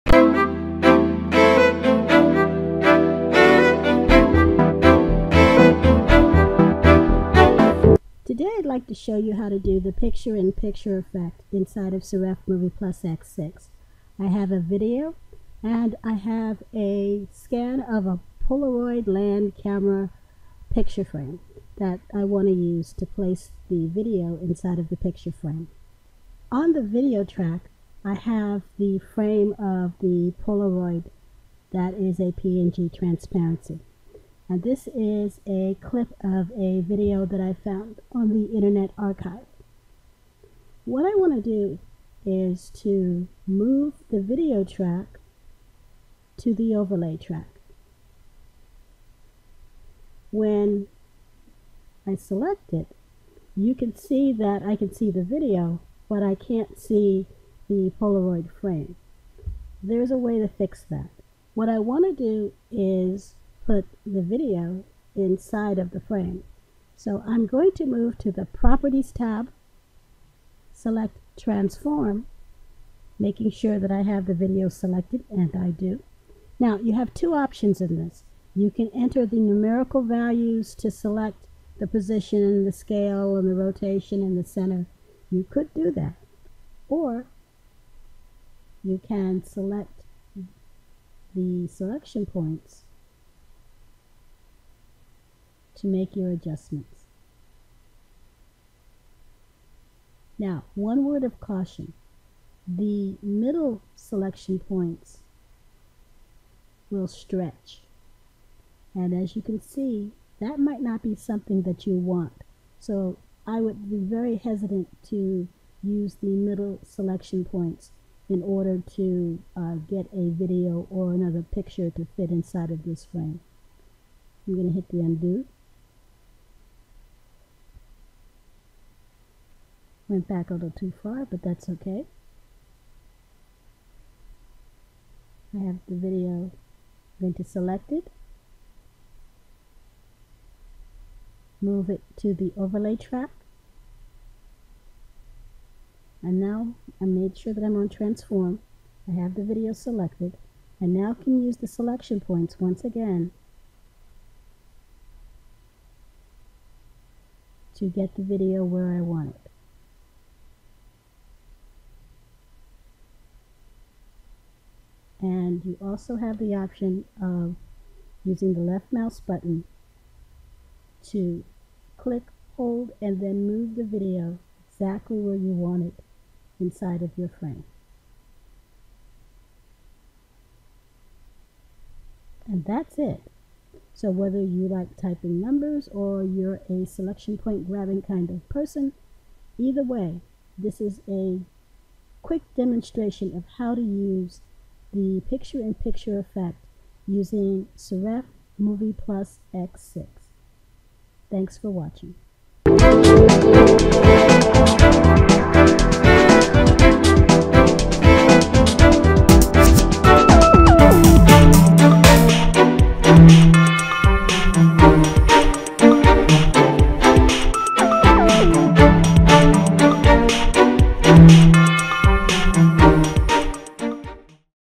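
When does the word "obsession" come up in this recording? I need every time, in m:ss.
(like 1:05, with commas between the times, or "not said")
not said.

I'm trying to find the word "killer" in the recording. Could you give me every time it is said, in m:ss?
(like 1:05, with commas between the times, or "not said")
not said.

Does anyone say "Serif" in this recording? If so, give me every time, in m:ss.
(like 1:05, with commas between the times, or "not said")
0:12, 3:17.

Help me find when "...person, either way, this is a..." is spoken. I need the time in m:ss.
3:08.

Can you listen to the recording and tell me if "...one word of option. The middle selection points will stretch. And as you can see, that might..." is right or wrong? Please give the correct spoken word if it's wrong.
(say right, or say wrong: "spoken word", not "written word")
wrong: "caution", not "option".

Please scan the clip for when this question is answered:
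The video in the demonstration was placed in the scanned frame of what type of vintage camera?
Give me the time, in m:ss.
0:18.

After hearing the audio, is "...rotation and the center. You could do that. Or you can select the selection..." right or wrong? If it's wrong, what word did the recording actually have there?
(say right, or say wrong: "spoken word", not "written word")
right.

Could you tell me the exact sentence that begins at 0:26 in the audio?
On the video track I have the frame of the Polaroid that is a PNG transparency.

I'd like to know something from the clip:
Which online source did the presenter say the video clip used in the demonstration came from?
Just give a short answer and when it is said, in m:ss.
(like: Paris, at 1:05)
Internet Archive, at 0:38.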